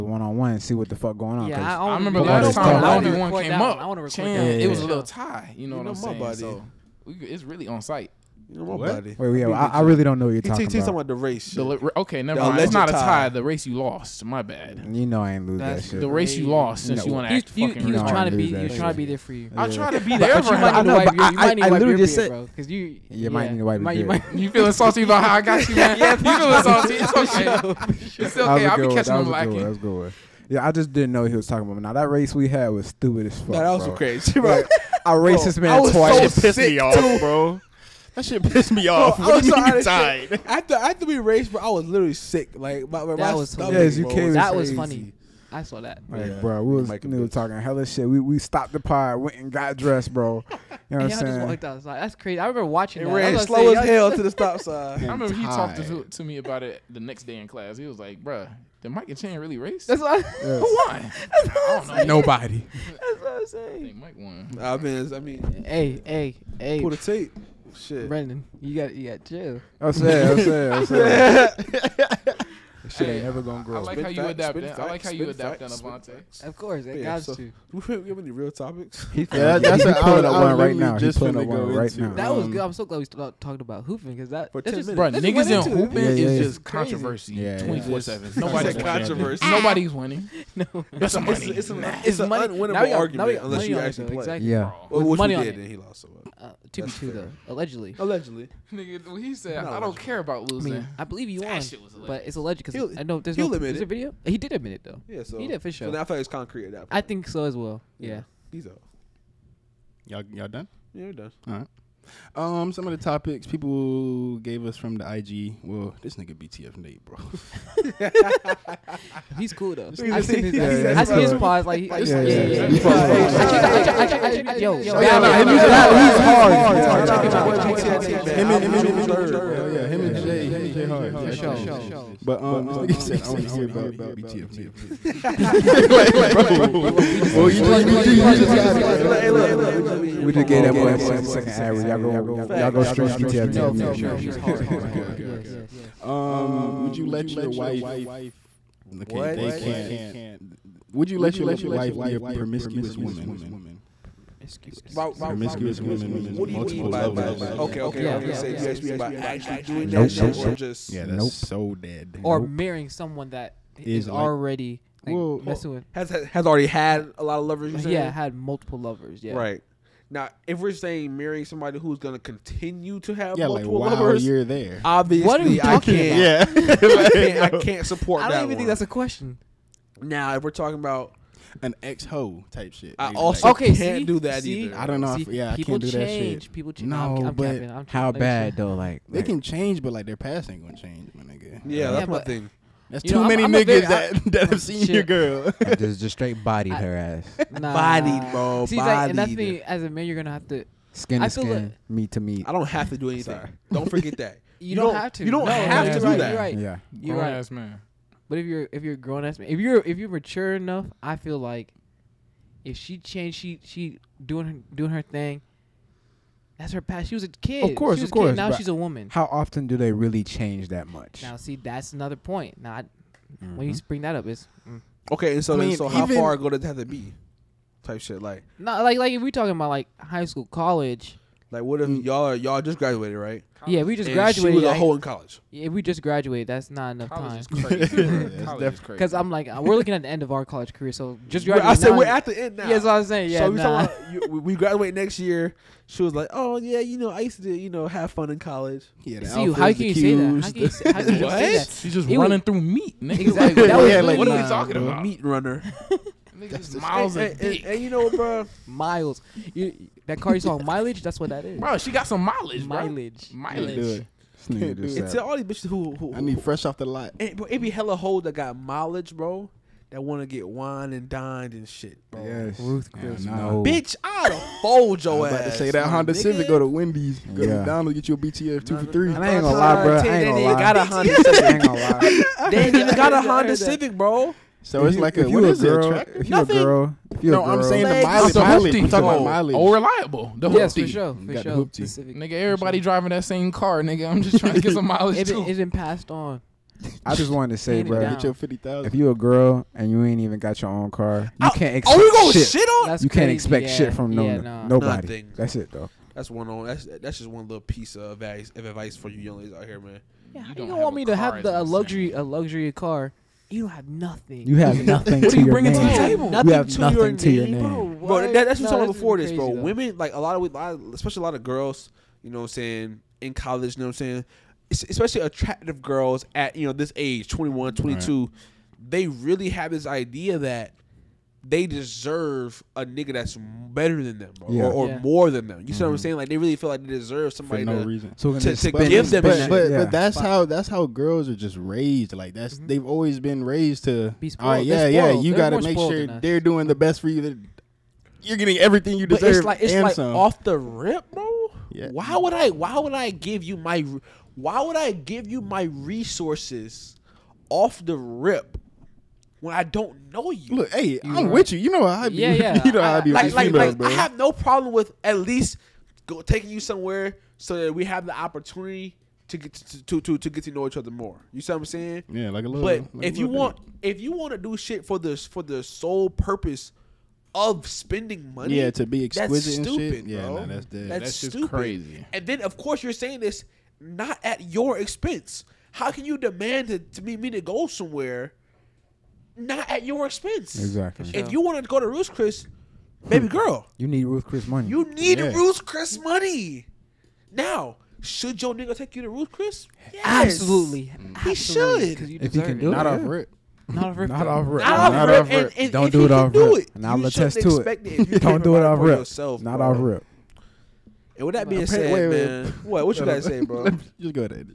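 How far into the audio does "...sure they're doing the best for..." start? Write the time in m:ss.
5:45.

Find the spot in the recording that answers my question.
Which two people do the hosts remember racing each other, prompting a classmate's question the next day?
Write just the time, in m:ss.
0:58.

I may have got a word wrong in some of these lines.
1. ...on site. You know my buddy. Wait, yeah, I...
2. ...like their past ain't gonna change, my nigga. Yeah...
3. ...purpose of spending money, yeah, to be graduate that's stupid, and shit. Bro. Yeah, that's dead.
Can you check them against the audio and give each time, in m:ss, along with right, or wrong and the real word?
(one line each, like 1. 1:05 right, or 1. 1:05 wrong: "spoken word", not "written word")
1. 0:07 right
2. 3:09 right
3. 6:16 wrong: "exquisite", not "graduate".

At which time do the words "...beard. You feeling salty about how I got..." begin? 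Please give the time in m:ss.
0:24.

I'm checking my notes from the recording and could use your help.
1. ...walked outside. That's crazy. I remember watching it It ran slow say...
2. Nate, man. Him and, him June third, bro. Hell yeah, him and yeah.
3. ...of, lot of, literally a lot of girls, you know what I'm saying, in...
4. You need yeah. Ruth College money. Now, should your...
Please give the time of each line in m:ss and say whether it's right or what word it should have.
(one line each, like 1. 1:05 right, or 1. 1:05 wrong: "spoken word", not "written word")
1. 0:51 right
2. 2:08 right
3. 5:20 wrong: "especially", not "literally"
4. 6:34 wrong: "Chris", not "College".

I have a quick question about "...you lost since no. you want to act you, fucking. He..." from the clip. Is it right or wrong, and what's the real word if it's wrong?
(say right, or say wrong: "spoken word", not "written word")
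right.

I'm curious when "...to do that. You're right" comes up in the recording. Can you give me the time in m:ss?
3:25.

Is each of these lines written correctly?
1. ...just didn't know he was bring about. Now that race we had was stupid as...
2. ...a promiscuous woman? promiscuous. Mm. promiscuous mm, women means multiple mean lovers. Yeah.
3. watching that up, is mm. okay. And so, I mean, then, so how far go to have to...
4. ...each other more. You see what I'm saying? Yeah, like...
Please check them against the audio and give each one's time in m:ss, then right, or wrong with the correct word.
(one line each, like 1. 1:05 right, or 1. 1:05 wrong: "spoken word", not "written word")
1. 0:30 wrong: "talking", not "bring"
2. 2:32 right
3. 3:43 wrong: "bring", not "watching"
4. 6:10 right.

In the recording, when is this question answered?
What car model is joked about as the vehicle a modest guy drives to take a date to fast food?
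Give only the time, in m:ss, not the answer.
4:43.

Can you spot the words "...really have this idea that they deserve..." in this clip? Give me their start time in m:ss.
5:29.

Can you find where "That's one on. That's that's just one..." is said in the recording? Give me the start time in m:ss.
5:06.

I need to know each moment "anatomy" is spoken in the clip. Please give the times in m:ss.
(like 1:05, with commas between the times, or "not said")
not said.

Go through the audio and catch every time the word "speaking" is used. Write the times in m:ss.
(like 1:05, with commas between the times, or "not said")
not said.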